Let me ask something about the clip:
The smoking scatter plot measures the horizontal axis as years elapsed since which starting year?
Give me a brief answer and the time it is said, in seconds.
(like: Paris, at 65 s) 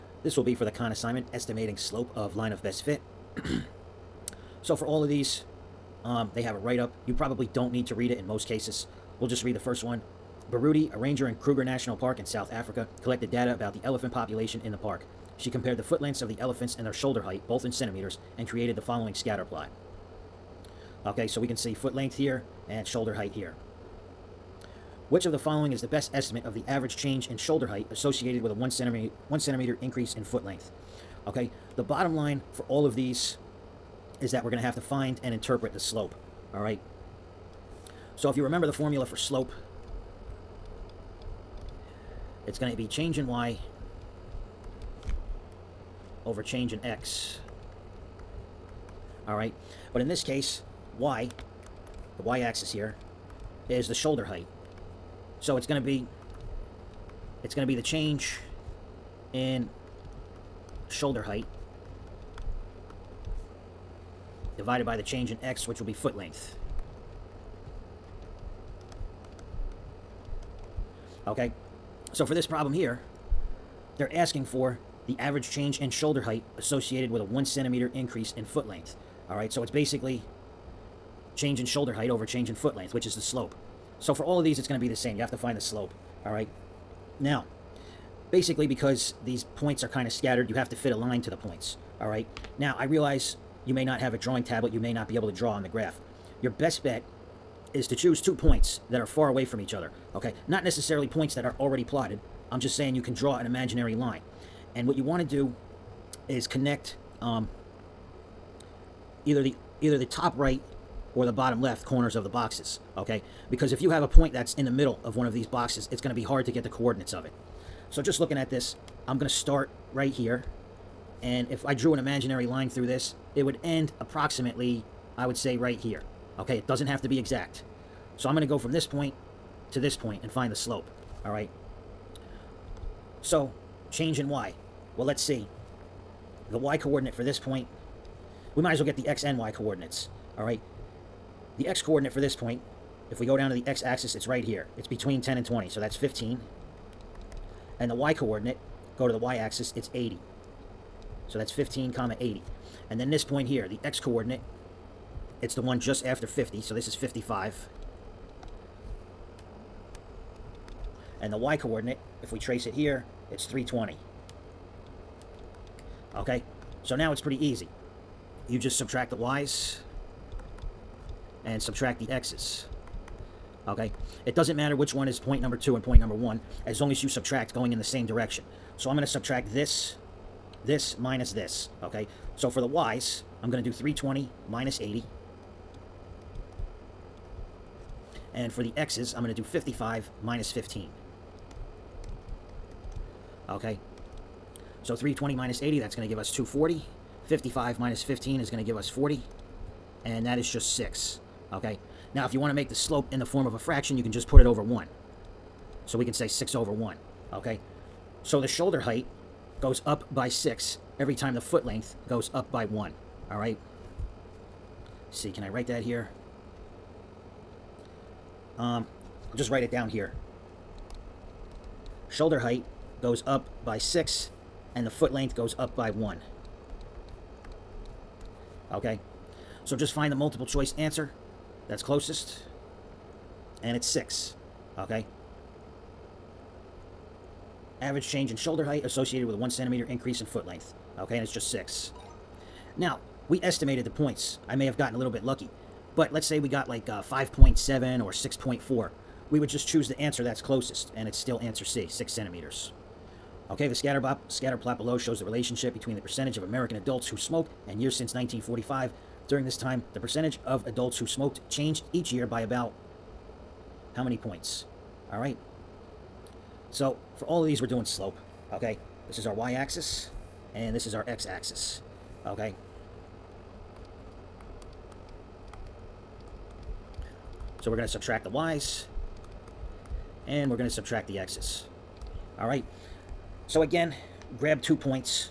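1945, at 258 s.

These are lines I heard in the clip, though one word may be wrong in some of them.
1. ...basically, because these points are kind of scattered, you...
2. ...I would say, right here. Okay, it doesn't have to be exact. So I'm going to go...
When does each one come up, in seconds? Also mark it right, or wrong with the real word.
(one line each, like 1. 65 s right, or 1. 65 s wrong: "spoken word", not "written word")
1. 88 s right
2. 125 s right.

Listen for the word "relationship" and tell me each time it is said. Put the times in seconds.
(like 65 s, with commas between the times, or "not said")
255 s.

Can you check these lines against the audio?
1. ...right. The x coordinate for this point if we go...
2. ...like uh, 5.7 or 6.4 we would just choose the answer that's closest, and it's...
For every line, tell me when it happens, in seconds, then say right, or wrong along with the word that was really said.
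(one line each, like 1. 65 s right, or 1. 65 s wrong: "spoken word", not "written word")
1. 140 s right
2. 246 s right.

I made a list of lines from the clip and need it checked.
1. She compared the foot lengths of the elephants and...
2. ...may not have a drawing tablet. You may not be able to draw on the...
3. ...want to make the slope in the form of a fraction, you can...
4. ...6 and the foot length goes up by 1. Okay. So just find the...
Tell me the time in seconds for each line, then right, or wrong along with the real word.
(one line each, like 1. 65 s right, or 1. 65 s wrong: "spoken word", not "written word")
1. 15 s right
2. 93 s right
3. 202 s right
4. 223 s right.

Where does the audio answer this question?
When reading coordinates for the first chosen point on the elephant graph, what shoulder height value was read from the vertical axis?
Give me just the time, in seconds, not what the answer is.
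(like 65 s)
149 s.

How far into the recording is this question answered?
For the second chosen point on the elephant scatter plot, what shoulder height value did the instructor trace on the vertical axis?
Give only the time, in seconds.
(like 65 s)
163 s.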